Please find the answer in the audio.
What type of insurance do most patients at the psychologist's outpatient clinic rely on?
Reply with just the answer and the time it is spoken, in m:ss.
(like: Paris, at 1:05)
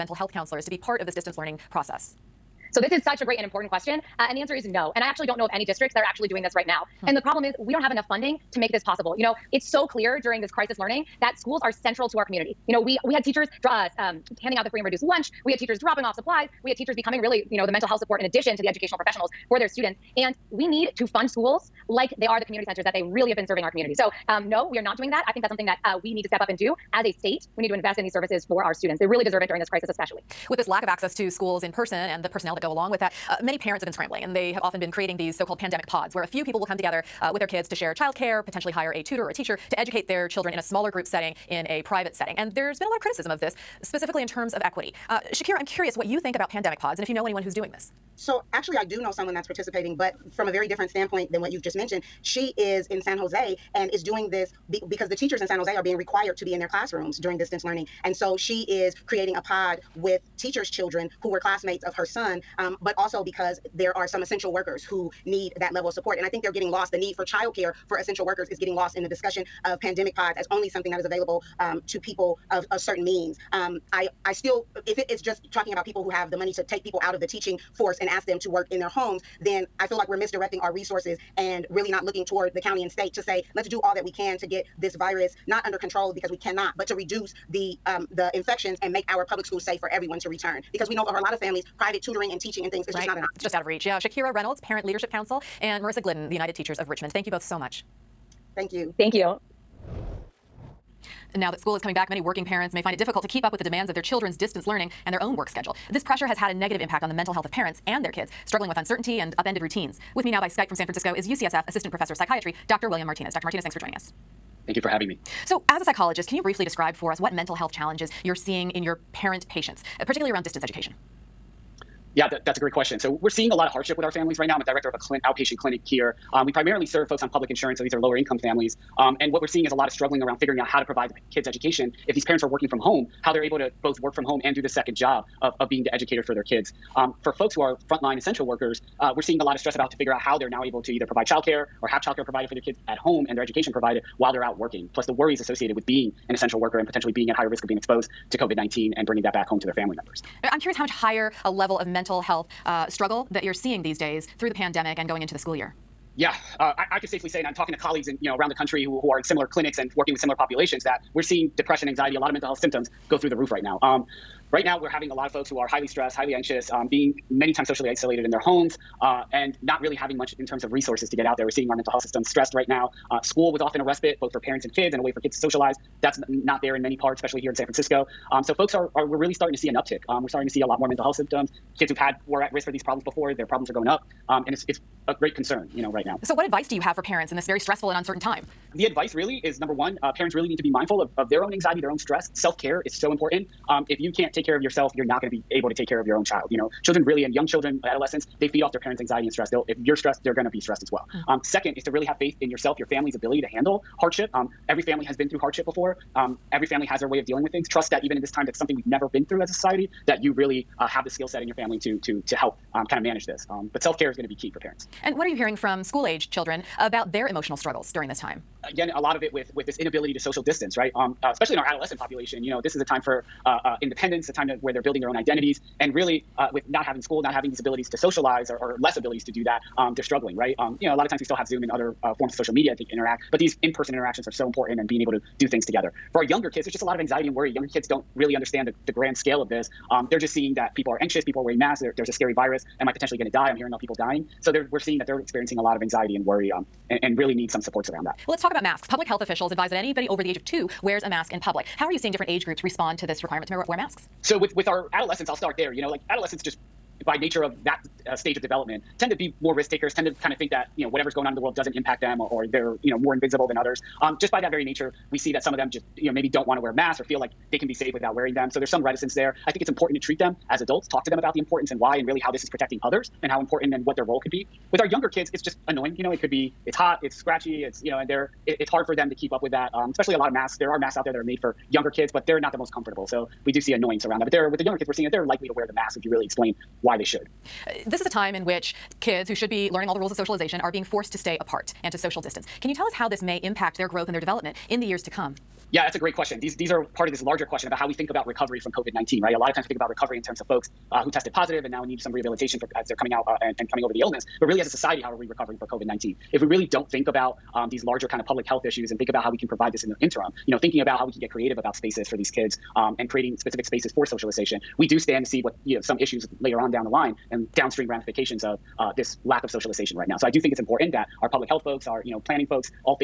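public insurance, at 2:07.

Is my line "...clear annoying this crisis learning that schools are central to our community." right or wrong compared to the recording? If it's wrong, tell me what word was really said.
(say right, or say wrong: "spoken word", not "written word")
wrong: "during", not "annoying".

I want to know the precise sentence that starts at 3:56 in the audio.
For our younger kids, there's just a lot of anxiety and worry.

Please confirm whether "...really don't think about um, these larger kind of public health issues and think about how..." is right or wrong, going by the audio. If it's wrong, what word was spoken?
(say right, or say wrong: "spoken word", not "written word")
right.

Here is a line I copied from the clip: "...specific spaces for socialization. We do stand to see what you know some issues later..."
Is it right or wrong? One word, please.
right.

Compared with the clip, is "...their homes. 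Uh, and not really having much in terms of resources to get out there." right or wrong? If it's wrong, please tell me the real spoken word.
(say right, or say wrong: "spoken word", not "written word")
right.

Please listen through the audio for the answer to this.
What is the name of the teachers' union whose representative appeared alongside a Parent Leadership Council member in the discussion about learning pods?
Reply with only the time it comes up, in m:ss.
1:36.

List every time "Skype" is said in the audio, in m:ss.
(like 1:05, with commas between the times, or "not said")
1:50.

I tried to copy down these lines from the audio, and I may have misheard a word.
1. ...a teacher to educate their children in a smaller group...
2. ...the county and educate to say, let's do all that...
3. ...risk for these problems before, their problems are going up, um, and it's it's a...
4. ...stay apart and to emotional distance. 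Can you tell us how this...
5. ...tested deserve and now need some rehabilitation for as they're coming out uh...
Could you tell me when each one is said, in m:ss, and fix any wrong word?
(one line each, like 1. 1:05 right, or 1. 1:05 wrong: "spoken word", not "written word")
1. 0:39 right
2. 1:22 wrong: "state", not "educate"
3. 3:02 right
4. 4:51 wrong: "social", not "emotional"
5. 5:01 wrong: "positive", not "deserve".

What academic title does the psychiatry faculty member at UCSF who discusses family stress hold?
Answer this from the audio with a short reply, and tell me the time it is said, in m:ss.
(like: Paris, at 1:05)
Assistant Professor, at 1:51.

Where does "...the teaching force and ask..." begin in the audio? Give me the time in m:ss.
1:17.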